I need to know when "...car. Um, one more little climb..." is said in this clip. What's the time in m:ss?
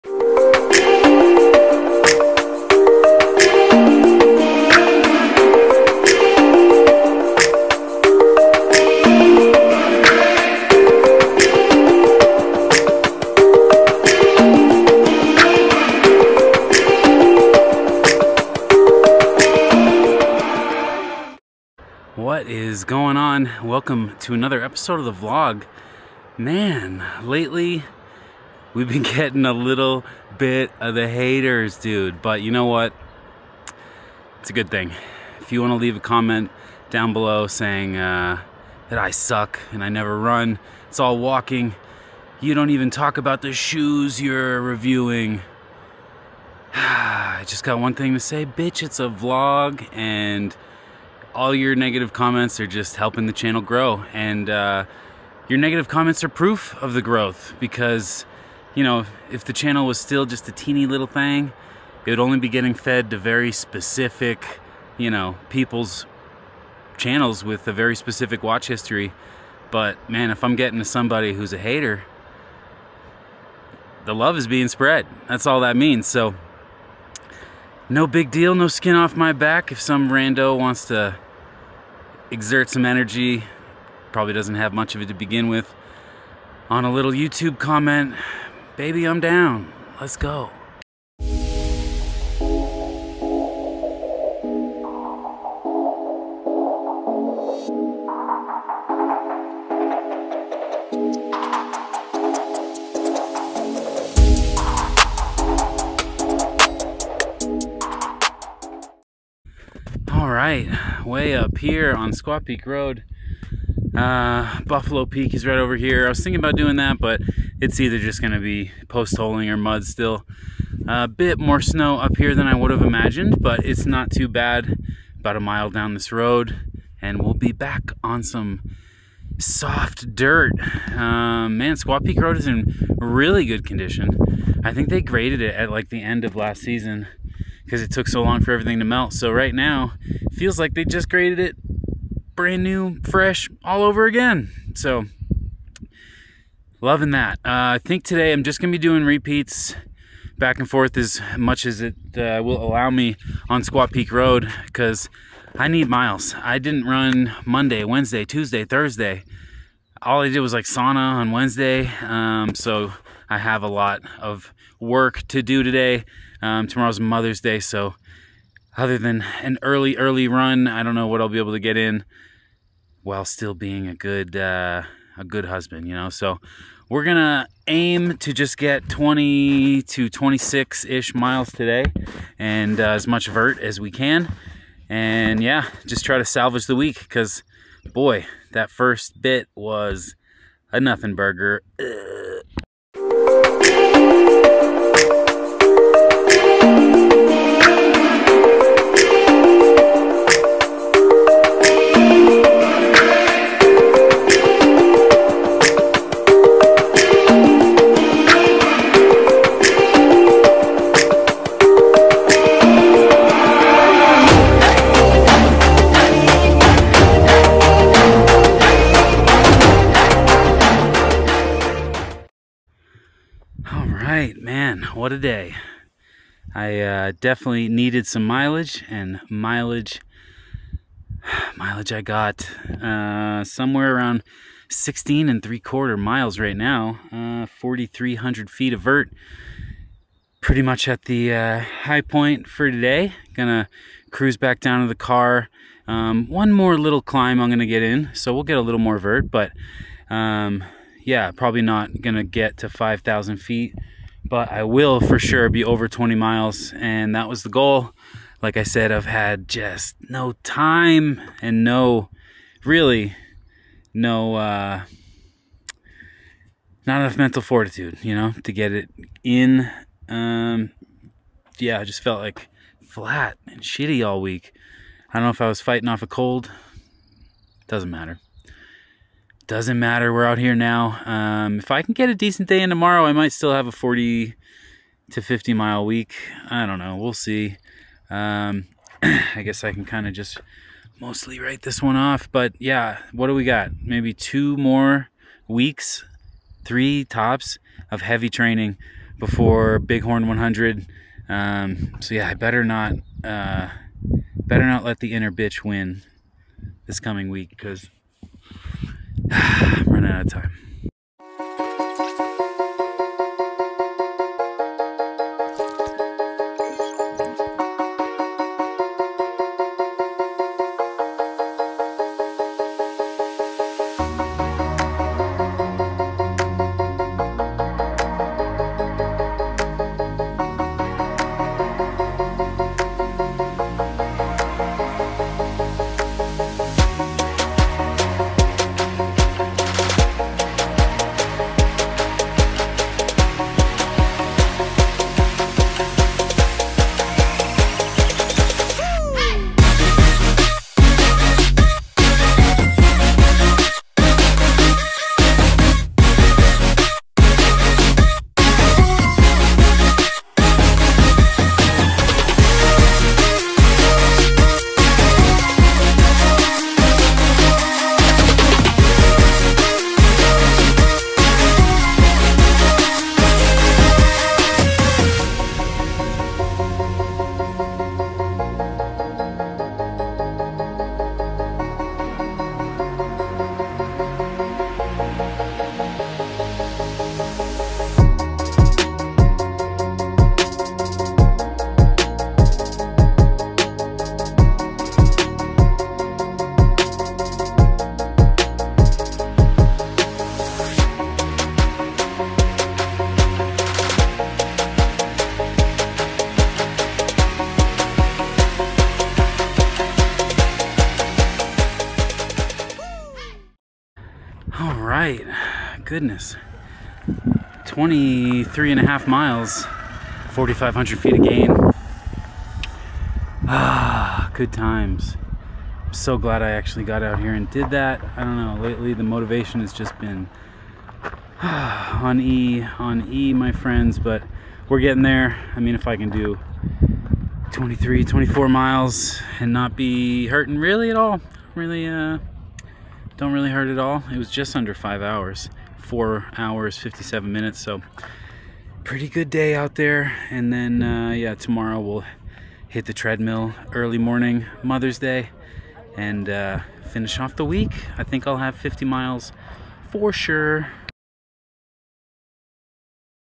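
4:04.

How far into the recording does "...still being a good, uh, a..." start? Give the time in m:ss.
2:53.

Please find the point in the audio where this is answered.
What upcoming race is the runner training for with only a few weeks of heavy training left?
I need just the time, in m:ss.
4:59.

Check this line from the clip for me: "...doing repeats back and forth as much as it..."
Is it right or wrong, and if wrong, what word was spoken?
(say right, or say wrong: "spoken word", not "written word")
right.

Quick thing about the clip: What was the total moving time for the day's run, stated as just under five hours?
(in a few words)
4 hours 57 minutes.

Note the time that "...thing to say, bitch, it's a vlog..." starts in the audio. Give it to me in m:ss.
0:47.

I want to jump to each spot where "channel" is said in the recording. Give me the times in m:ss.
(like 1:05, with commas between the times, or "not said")
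0:53, 0:59, 1:06.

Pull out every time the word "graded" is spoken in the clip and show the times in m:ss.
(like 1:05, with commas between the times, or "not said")
2:15, 2:21.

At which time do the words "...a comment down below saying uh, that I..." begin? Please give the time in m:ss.
0:35.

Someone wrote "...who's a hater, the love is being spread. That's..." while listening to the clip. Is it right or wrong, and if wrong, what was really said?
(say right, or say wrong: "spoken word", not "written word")
right.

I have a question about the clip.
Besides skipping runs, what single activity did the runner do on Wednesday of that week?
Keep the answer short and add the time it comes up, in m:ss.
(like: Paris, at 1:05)
sauna, at 2:40.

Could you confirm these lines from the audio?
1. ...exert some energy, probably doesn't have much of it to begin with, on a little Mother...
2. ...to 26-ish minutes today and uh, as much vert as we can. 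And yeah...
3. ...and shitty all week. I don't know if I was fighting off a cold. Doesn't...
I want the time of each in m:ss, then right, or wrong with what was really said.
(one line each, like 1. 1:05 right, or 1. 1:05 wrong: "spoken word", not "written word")
1. 1:22 wrong: "YouTube", not "Mother"
2. 2:59 wrong: "miles", not "minutes"
3. 4:33 right.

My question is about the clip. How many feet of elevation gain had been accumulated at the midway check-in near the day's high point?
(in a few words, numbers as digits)
4,300 feet.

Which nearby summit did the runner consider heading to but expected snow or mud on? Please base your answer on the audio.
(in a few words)
Buffalo Peak.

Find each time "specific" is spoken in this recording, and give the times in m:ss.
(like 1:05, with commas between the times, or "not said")
1:03, 1:07.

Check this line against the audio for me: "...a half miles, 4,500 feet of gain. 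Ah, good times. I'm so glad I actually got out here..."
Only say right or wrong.
right.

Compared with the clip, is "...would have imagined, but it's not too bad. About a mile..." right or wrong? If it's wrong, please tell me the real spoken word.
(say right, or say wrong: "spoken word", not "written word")
right.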